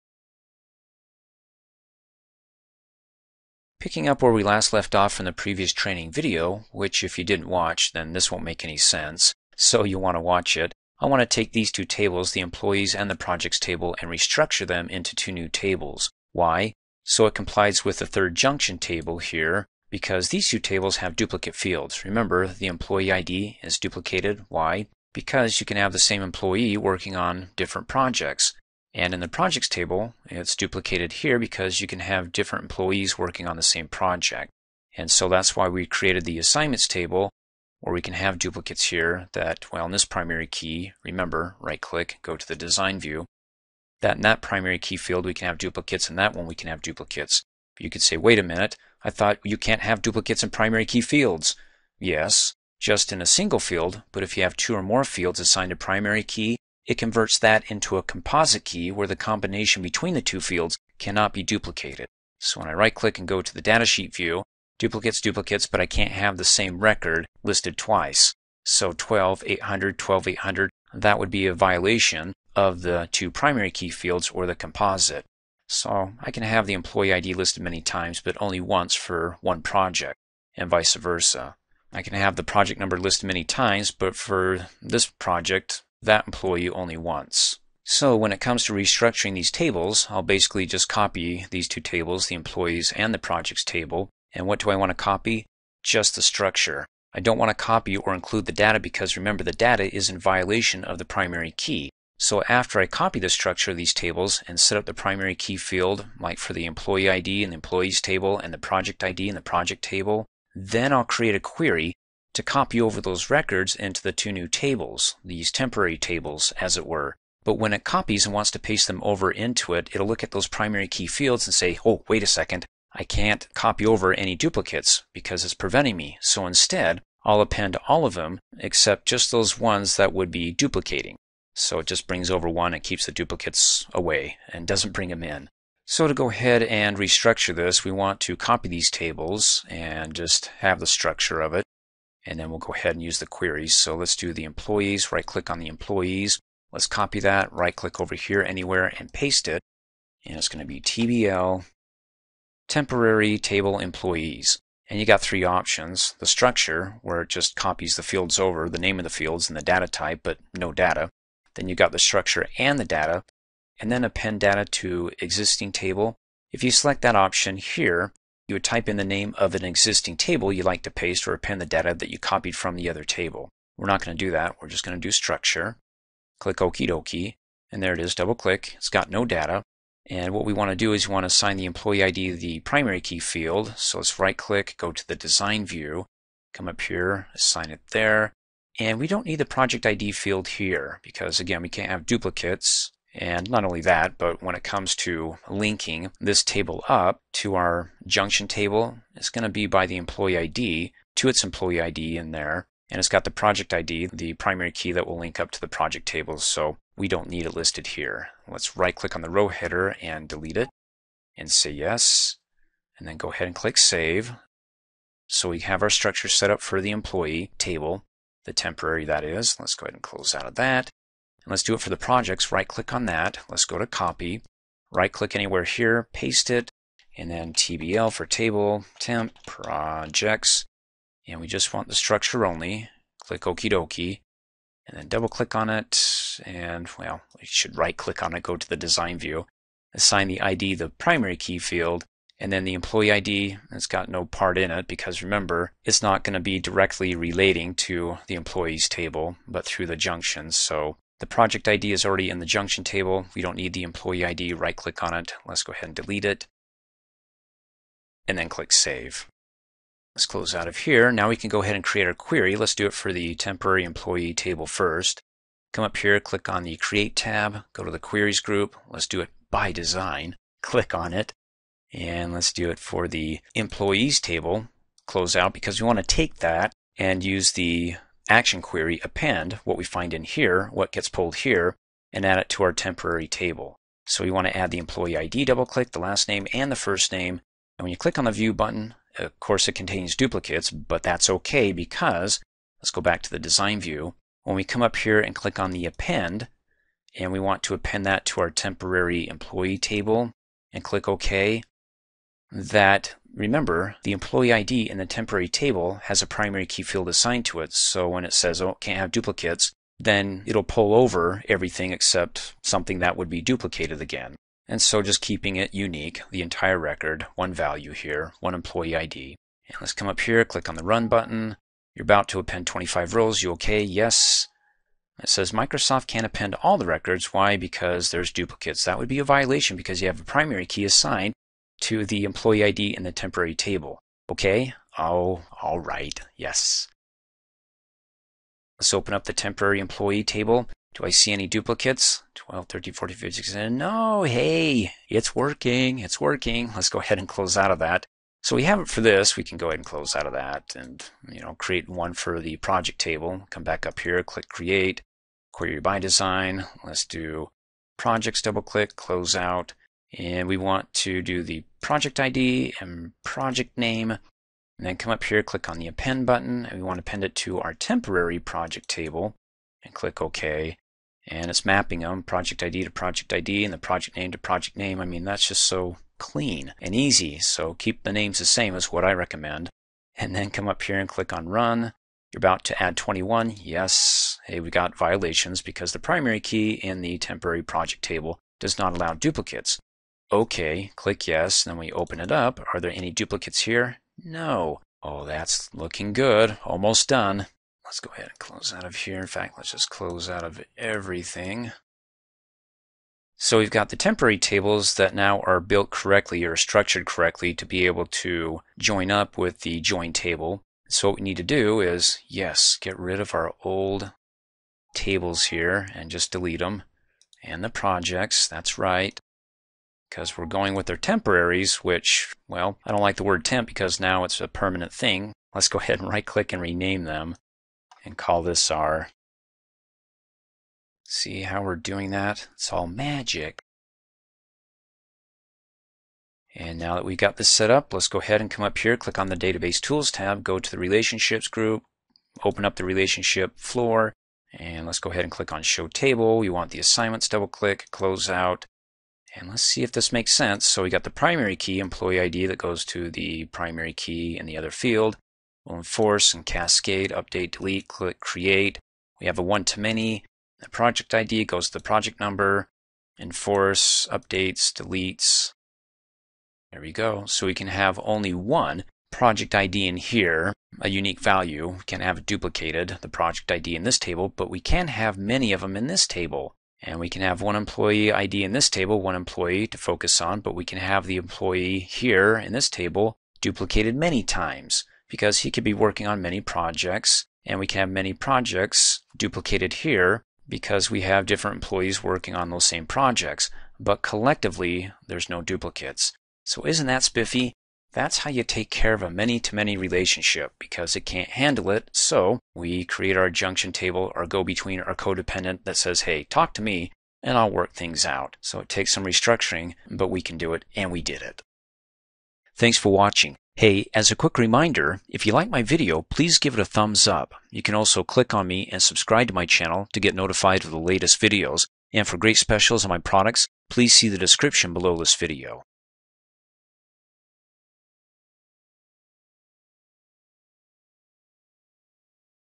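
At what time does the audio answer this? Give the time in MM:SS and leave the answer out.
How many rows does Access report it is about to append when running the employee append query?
05:22.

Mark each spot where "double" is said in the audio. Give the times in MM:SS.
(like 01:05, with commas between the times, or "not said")
02:58, 03:55, 04:45, 05:58, 07:27.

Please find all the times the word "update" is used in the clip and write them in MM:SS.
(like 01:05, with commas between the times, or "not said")
07:37, 07:44.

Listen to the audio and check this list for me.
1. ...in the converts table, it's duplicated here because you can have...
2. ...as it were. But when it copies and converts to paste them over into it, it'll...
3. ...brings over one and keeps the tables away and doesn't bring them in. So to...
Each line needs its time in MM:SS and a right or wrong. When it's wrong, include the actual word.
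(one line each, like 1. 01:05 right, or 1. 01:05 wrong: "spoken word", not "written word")
1. 00:29 wrong: "projects", not "converts"
2. 01:56 wrong: "wants", not "converts"
3. 02:12 wrong: "duplicates", not "tables".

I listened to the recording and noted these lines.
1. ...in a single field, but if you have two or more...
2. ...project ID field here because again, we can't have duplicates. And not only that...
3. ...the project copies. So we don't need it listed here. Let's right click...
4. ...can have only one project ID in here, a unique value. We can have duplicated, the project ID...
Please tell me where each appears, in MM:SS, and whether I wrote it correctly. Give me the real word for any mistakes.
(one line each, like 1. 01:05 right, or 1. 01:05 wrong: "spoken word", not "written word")
1. 00:53 right
2. 03:09 right
3. 03:25 wrong: "tables", not "copies"
4. 07:47 right.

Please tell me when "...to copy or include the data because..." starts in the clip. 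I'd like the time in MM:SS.
01:37.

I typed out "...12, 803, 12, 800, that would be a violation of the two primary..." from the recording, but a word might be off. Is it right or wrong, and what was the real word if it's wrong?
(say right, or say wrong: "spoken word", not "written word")
wrong: "800", not "803".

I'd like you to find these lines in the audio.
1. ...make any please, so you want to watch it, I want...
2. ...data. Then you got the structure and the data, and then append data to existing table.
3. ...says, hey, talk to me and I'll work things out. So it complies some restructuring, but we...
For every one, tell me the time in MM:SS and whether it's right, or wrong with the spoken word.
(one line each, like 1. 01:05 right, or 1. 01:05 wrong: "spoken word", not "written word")
1. 00:08 wrong: "sense", not "please"
2. 02:40 right
3. 08:25 wrong: "takes", not "complies".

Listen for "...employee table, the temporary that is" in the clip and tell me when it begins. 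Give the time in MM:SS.
03:36.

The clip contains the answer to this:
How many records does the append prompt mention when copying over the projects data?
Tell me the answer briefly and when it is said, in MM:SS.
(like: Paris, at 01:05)
21, at 06:22.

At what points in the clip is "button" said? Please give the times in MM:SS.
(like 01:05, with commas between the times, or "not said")
04:48, 05:21, 06:06.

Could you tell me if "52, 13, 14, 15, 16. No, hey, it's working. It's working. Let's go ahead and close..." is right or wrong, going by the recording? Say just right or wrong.
wrong.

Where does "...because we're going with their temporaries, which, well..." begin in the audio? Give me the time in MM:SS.
07:00.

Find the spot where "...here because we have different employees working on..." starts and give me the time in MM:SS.
08:09.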